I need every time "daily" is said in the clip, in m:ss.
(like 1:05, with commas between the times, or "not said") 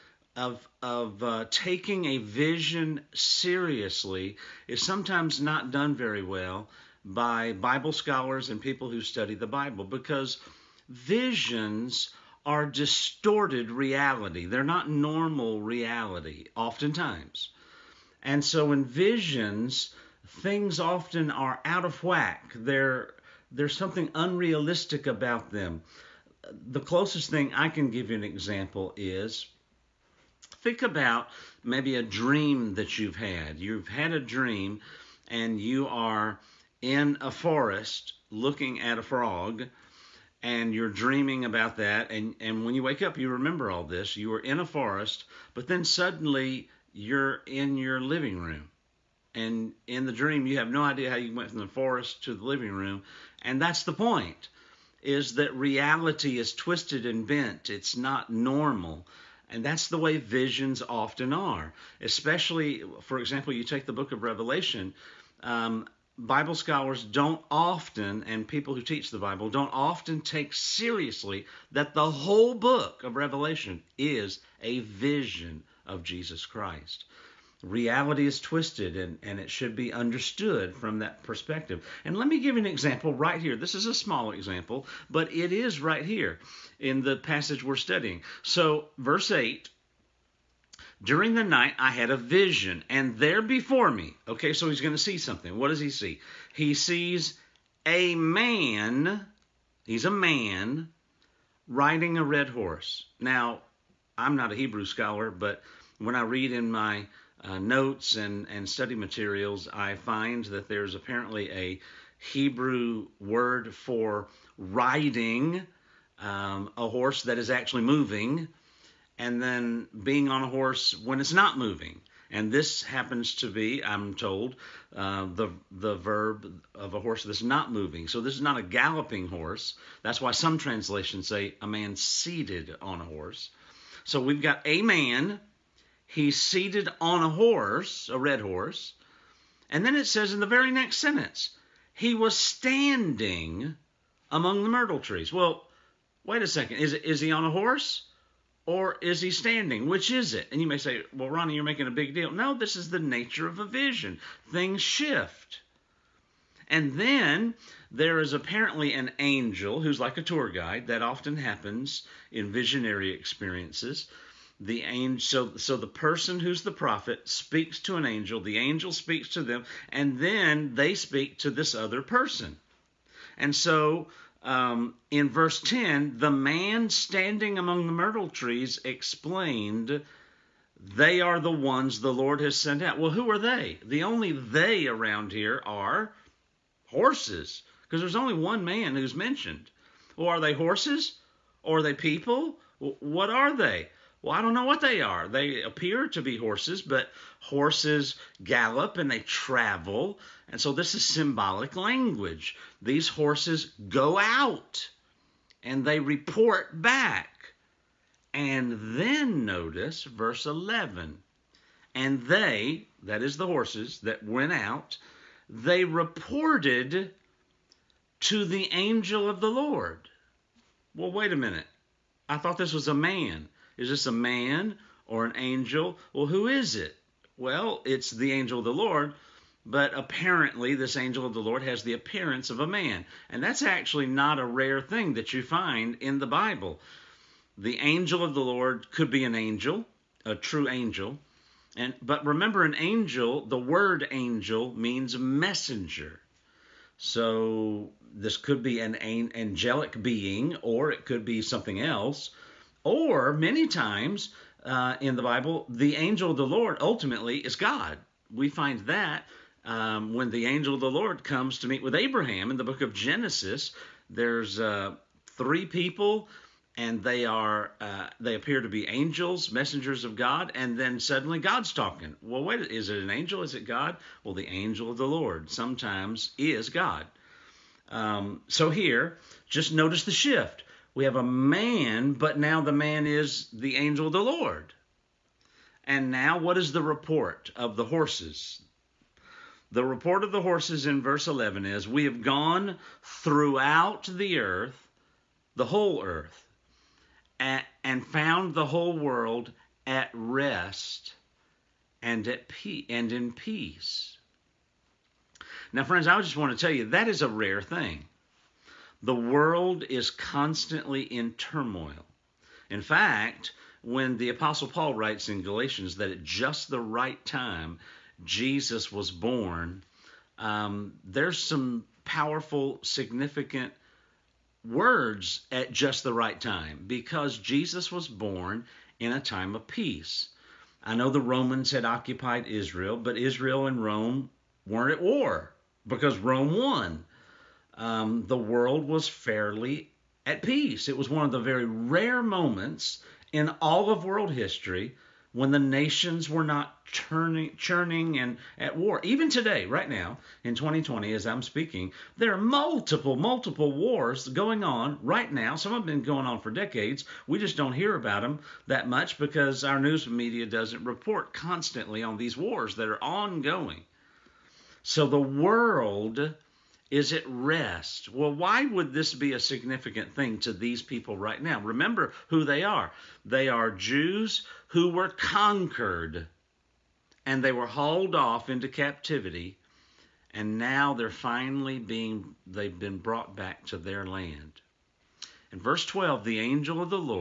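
not said.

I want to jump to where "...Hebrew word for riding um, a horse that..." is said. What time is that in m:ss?
1:52.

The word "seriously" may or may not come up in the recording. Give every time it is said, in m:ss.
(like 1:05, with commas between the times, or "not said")
0:03, 1:10.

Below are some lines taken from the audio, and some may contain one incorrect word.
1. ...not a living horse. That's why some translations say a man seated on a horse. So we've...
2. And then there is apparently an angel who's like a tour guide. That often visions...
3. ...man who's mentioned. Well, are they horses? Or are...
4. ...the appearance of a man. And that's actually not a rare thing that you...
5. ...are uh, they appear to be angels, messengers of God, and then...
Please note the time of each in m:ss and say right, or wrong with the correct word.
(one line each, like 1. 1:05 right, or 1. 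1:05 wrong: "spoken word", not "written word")
1. 2:08 wrong: "galloping", not "living"
2. 2:36 wrong: "happens", not "visions"
3. 3:08 right
4. 3:51 right
5. 4:27 right.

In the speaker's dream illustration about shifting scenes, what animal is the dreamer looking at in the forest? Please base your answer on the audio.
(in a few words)
frog.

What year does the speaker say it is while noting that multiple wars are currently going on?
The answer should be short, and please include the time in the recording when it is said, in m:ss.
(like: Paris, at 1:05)
2020, at 5:50.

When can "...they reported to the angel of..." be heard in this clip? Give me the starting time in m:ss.
3:35.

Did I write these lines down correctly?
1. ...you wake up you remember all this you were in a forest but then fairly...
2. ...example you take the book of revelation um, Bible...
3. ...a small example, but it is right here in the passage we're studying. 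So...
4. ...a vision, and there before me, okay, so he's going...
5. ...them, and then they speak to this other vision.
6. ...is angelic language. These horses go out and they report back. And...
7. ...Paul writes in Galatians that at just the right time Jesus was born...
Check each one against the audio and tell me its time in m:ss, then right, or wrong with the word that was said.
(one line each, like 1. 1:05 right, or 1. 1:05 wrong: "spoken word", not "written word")
1. 0:42 wrong: "suddenly", not "fairly"
2. 1:03 right
3. 1:23 right
4. 1:32 right
5. 2:49 wrong: "person", not "vision"
6. 3:20 wrong: "symbolic", not "angelic"
7. 5:14 right.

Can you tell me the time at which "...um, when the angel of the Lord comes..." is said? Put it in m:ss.
4:19.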